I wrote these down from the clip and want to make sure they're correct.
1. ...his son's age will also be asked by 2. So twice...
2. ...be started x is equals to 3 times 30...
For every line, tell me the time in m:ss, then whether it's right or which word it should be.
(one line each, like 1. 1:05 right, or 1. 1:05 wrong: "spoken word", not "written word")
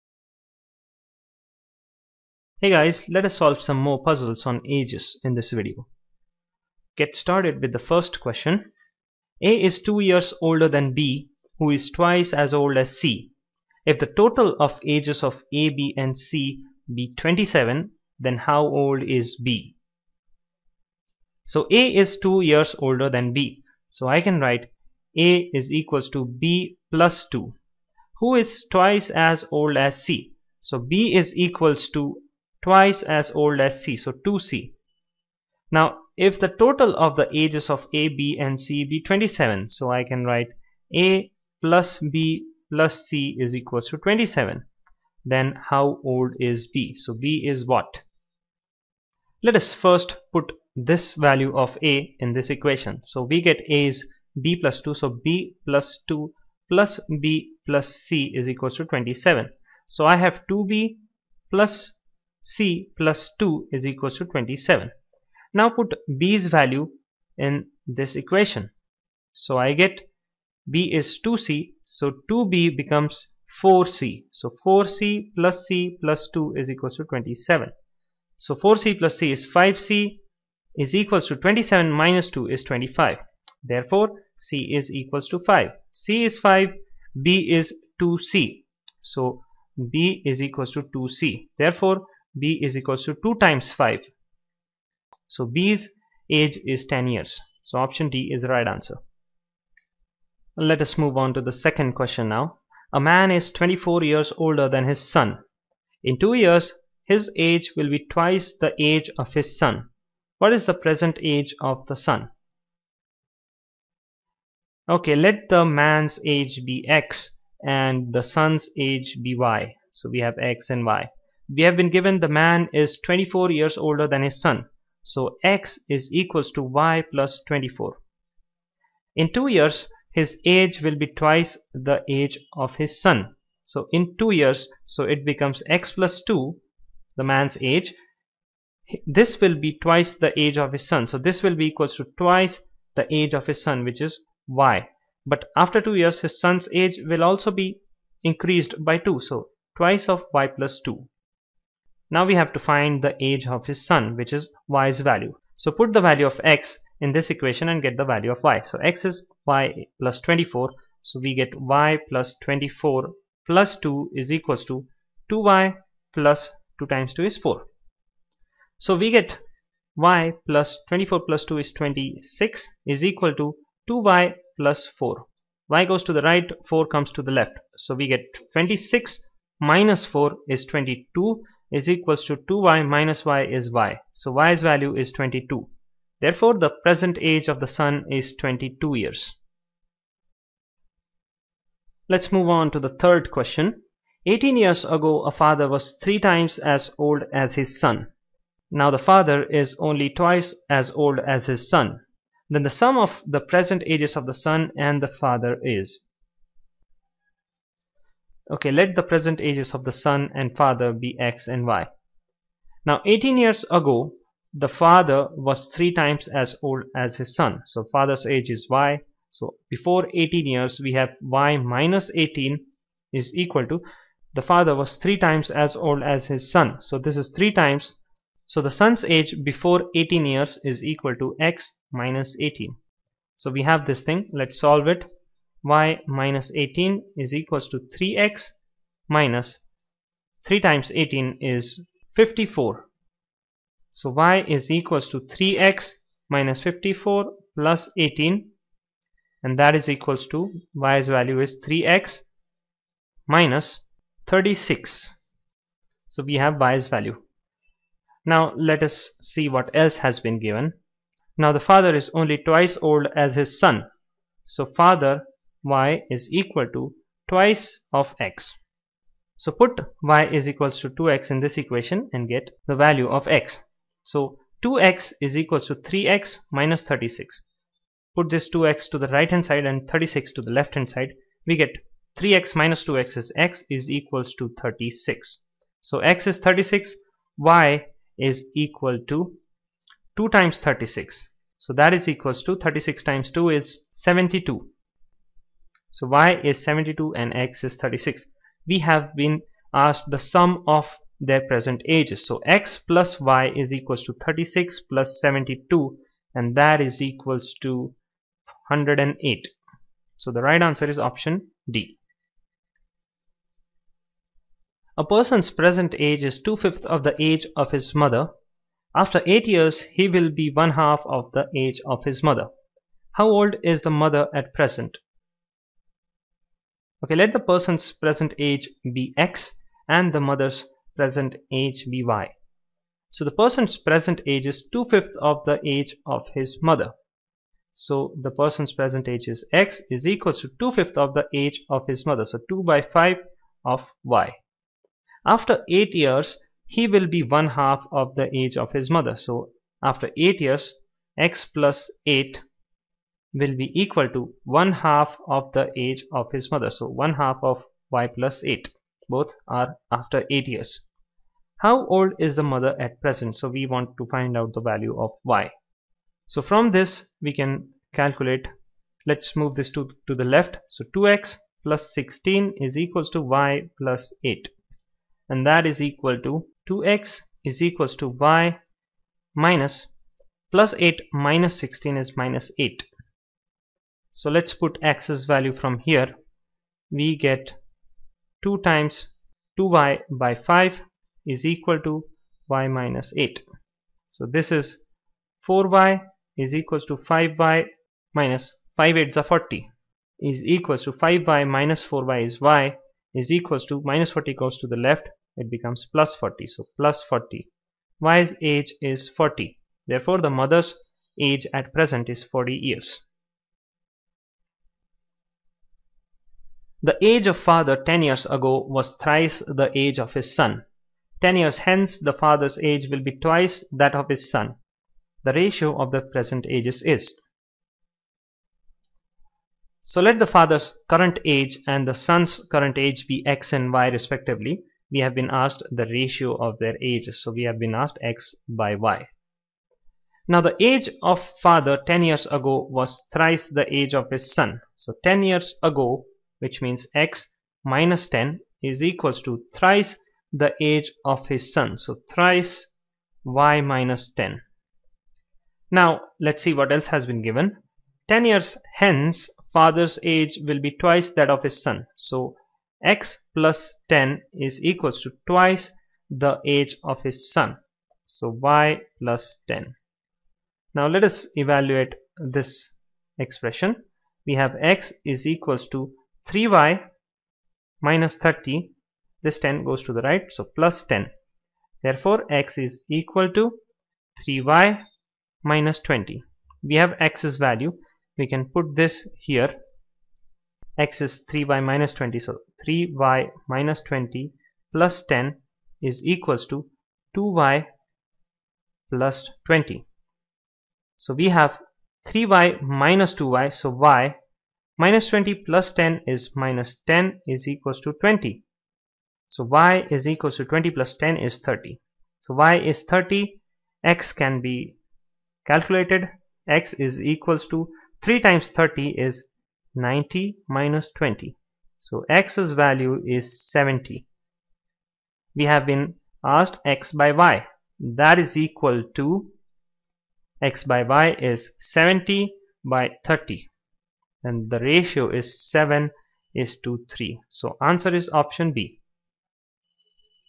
1. 2:26 wrong: "increased", not "asked"
2. 8:34 wrong: "calculated", not "started".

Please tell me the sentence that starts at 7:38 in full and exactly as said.
10 years hence father's age will be twice that of his son.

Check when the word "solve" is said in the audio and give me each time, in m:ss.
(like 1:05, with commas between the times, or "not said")
0:03, 3:54.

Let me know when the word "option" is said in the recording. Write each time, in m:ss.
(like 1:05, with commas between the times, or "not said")
1:37, 5:10, 8:58.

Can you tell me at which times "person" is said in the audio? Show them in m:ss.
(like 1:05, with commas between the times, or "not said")
5:15, 5:27, 5:33, 5:38.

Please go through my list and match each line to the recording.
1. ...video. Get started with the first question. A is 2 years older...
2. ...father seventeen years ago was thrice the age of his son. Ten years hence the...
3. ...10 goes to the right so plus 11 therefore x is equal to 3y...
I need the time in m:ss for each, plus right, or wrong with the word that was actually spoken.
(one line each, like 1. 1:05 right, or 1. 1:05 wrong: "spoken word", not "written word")
1. 0:05 right
2. 6:57 wrong: "ten", not "seventeen"
3. 7:59 wrong: "10", not "11".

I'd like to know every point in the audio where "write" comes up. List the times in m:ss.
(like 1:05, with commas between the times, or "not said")
0:24, 0:40.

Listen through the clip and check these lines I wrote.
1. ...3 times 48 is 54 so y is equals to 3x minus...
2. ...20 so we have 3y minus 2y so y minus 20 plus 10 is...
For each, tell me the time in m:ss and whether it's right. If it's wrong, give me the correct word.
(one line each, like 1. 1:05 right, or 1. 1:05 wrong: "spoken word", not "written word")
1. 4:00 wrong: "18", not "48"
2. 8:19 right.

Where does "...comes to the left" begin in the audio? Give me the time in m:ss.
2:56.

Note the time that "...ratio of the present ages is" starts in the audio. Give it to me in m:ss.
7:05.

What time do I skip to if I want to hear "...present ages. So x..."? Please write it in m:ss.
5:01.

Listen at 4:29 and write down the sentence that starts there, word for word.
So put y is equals to 2x in this equation and get the value of x.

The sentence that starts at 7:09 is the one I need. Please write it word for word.
So let the father's current age and the son's current age be x and y respectively.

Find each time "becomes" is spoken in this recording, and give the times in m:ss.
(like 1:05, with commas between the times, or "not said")
1:12, 2:15, 6:45.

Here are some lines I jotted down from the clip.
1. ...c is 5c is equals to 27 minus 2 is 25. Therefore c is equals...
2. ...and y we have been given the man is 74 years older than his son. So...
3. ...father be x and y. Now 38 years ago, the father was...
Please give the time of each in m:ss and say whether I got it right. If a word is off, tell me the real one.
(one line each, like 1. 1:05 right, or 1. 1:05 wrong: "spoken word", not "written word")
1. 1:19 right
2. 2:00 wrong: "24", not "74"
3. 3:30 wrong: "18", not "38".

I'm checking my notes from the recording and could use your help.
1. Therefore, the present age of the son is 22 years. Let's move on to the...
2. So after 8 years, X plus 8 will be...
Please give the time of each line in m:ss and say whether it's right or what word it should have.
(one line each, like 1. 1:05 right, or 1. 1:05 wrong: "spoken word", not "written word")
1. 3:06 right
2. 5:49 right.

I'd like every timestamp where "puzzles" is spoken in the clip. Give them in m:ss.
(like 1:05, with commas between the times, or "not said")
0:04.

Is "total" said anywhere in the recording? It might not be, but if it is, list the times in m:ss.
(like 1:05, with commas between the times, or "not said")
0:14, 0:36.